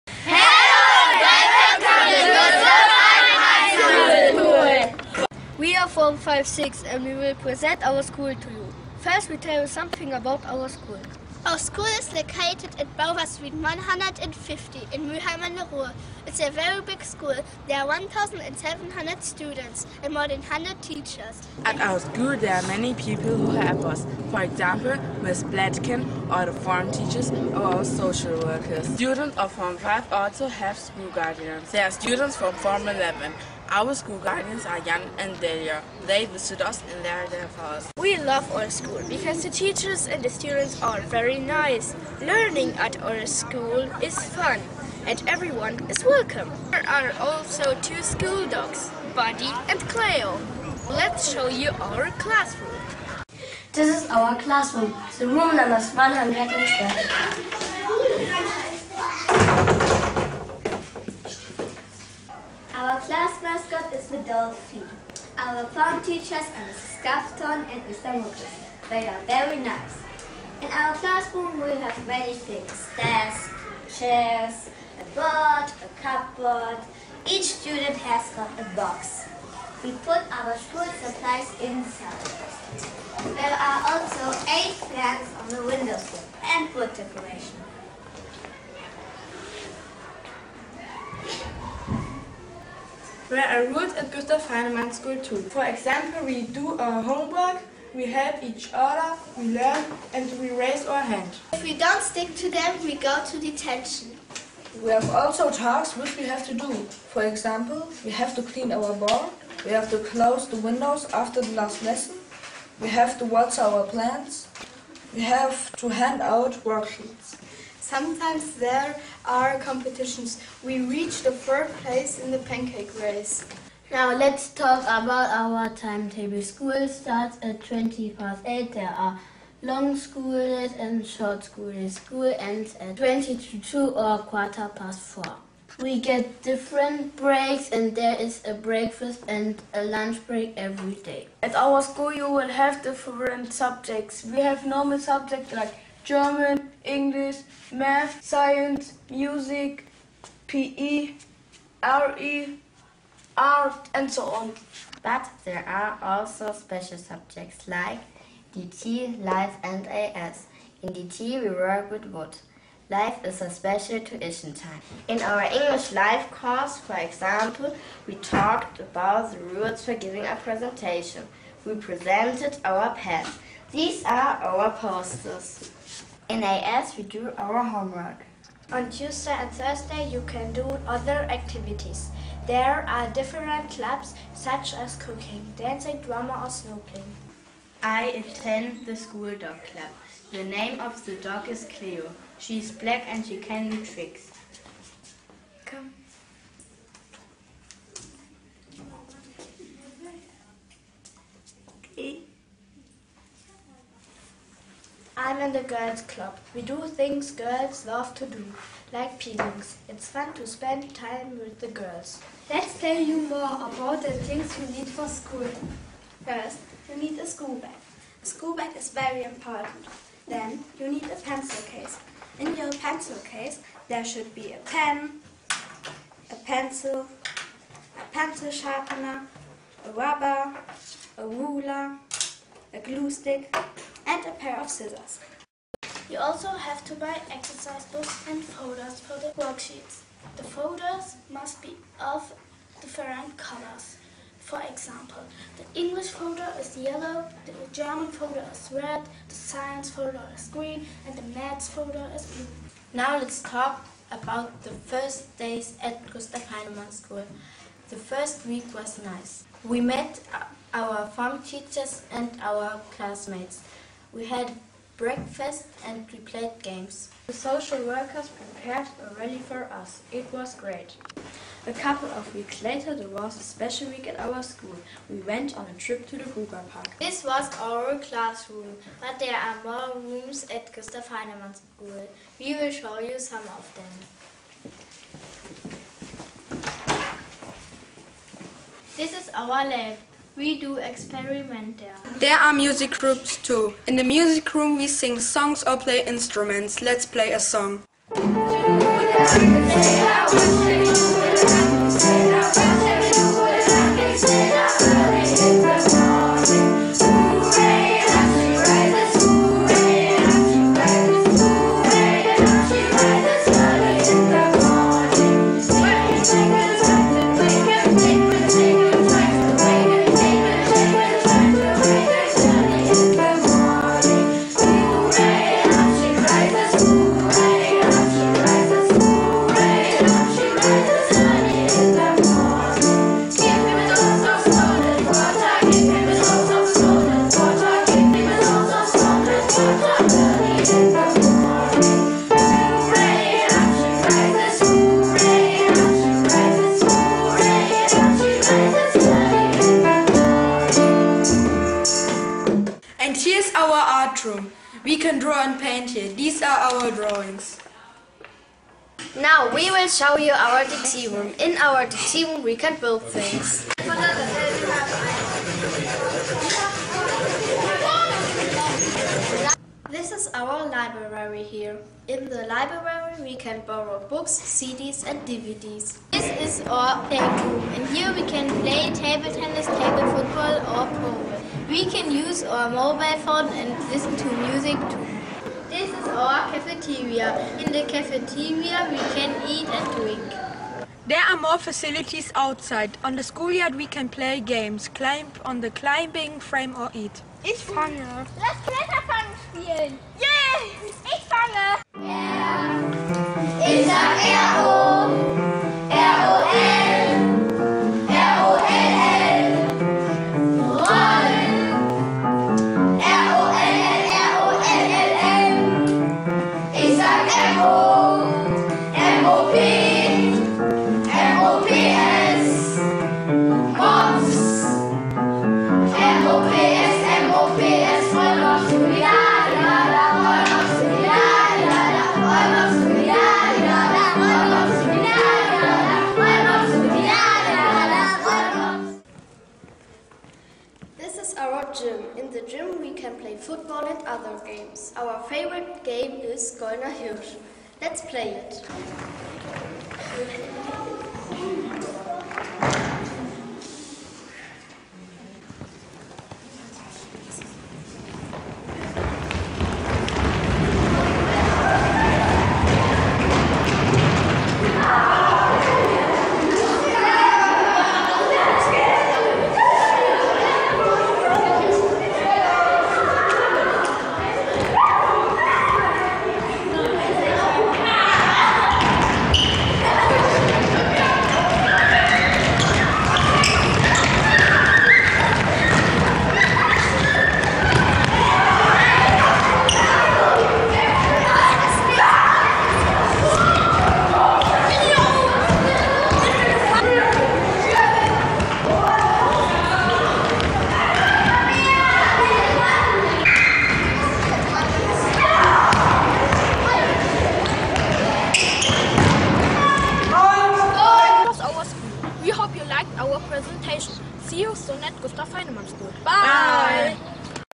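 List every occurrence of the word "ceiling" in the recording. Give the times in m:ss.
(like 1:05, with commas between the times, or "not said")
not said.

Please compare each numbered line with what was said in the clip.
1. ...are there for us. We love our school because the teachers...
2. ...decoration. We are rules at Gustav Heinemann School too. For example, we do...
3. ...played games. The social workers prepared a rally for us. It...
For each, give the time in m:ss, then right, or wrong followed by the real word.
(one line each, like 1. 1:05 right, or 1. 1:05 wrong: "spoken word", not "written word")
1. 0:37 right
2. 1:26 right
3. 4:26 right.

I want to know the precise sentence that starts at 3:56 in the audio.
You also have to buy exercise books and folders for the worksheets.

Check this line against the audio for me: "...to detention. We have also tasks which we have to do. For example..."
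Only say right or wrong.
right.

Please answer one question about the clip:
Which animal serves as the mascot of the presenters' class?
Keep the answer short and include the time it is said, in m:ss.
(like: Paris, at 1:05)
dolphin, at 1:04.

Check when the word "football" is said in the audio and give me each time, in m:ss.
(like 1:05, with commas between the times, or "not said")
6:20, 7:23.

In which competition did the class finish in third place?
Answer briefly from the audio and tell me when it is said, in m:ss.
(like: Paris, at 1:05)
pancake race, at 2:02.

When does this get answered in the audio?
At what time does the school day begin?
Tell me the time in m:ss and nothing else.
2:07.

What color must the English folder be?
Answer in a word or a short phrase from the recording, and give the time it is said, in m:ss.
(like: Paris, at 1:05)
yellow, at 4:06.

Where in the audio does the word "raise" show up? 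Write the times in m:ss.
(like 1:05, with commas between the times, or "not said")
1:40.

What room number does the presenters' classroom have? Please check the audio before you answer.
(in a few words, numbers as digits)
112.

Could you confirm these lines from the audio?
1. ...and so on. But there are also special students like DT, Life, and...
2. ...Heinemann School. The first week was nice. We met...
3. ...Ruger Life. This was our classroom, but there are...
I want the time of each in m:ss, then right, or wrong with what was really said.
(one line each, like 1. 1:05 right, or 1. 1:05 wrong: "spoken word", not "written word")
1. 2:33 wrong: "subjects", not "students"
2. 4:16 right
3. 4:36 wrong: "Park", not "Life".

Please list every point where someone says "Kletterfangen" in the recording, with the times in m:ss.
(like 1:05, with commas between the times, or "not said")
6:38.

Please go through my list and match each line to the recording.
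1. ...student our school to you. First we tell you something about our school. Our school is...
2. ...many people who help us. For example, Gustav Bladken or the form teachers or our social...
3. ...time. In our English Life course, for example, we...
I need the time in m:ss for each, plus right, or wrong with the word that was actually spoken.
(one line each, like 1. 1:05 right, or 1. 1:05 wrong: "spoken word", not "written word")
1. 0:07 wrong: "present", not "student"
2. 0:22 wrong: "Miss", not "Gustav"
3. 2:44 right.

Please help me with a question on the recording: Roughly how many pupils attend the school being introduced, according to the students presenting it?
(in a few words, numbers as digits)
1,700.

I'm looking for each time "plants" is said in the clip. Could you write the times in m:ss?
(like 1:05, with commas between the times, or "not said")
1:24, 1:53.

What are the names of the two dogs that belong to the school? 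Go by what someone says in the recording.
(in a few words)
Buddy and Cleo.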